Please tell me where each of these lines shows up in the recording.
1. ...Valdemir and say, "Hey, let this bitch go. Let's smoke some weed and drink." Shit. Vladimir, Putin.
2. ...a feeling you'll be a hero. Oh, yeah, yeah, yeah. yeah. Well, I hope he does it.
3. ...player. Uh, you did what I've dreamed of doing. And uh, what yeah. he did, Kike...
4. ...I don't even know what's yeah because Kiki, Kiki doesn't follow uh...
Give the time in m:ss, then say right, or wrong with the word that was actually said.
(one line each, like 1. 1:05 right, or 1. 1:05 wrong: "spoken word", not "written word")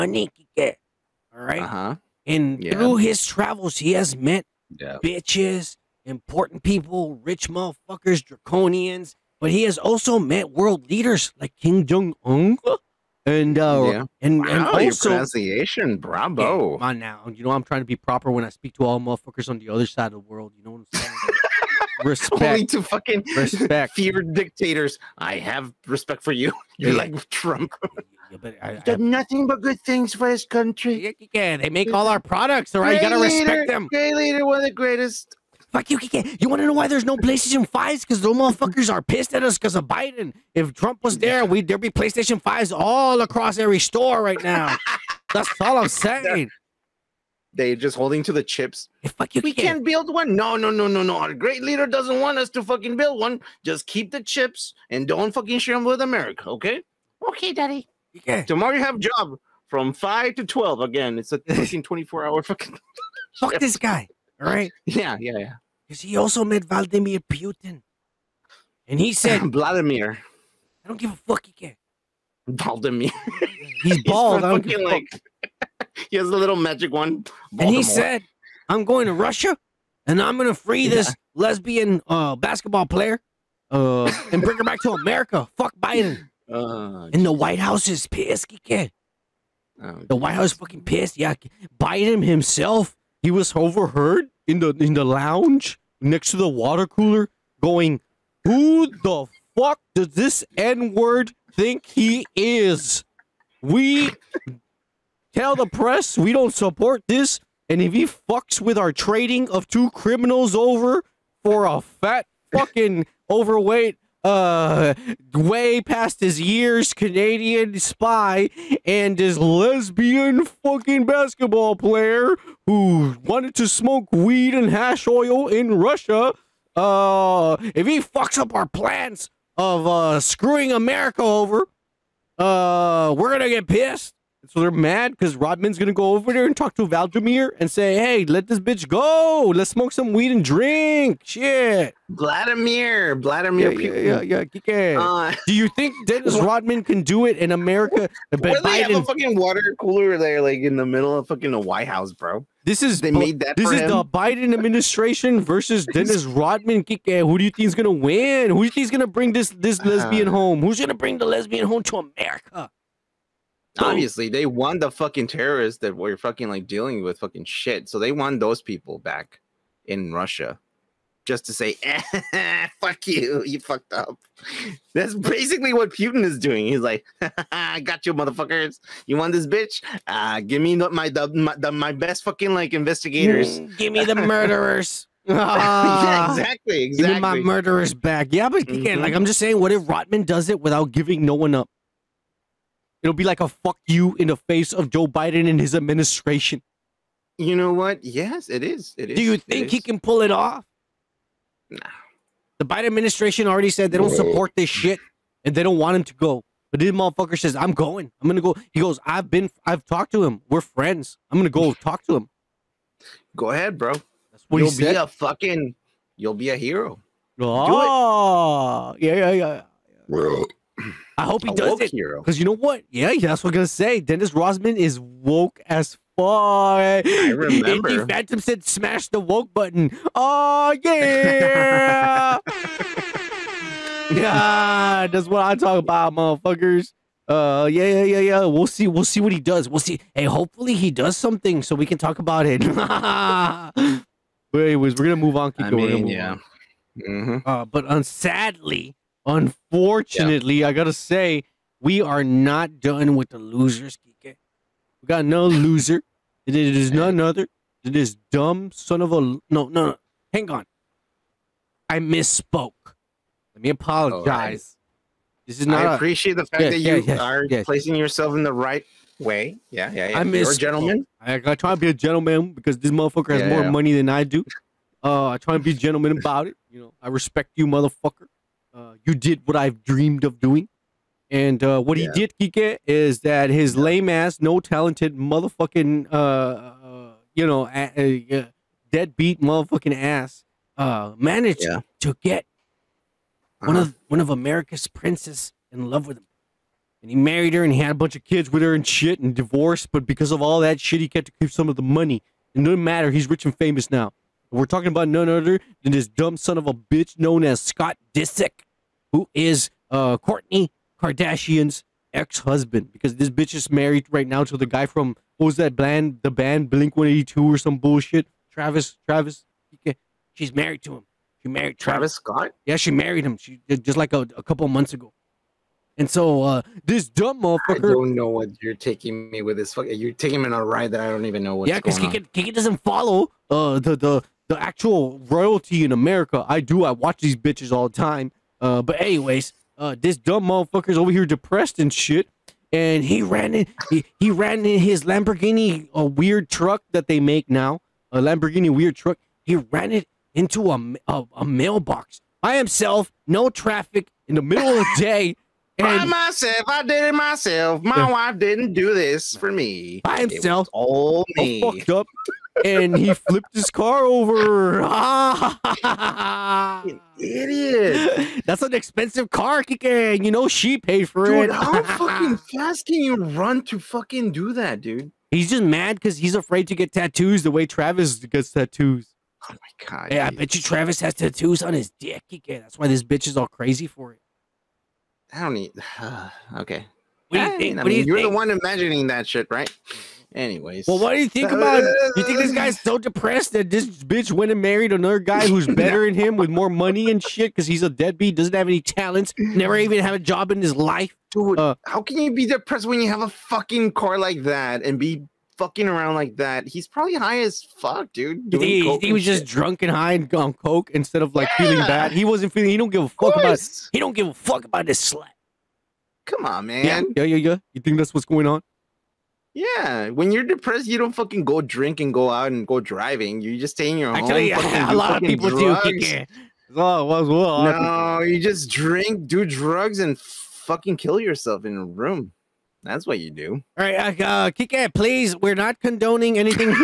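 1. 2:16 wrong: "Vladimir", not "Putin"
2. 3:34 wrong: "fucking", not "feeling"
3. 4:37 wrong: "motherfucker", not "player"
4. 5:31 right.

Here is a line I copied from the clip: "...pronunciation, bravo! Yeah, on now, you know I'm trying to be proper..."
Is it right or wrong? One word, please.
right.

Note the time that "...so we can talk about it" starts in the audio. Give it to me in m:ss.
4:01.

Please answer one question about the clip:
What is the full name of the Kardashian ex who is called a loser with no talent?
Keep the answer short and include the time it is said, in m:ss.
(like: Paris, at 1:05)
Scott Disick, at 5:07.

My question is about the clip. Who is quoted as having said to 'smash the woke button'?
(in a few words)
Indy Phantom.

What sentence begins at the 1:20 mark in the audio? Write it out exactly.
this lesbian uh, basketball player, uh, and bring her back to America.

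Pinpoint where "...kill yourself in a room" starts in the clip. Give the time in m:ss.
7:10.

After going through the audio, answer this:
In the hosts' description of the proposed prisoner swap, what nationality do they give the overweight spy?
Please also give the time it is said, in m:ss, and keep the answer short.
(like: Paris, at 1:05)
Canadian, at 1:56.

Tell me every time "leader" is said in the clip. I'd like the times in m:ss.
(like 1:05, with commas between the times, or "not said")
0:10, 0:34, 0:51.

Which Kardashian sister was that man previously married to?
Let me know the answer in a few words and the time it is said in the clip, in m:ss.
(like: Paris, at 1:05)
Kourtney Kardashian, at 5:10.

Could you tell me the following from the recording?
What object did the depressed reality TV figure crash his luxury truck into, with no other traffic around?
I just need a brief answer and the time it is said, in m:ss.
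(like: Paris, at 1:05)
A mailbox, at 5:51.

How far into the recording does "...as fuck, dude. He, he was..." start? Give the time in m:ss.
6:47.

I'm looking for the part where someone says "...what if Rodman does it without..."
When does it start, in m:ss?
3:09.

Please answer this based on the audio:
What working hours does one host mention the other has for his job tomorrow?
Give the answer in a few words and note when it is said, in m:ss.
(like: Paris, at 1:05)
5 to 12, at 0:59.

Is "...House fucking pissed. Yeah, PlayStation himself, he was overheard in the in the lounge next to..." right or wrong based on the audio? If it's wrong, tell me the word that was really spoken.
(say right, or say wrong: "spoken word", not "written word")
wrong: "Biden", not "PlayStation".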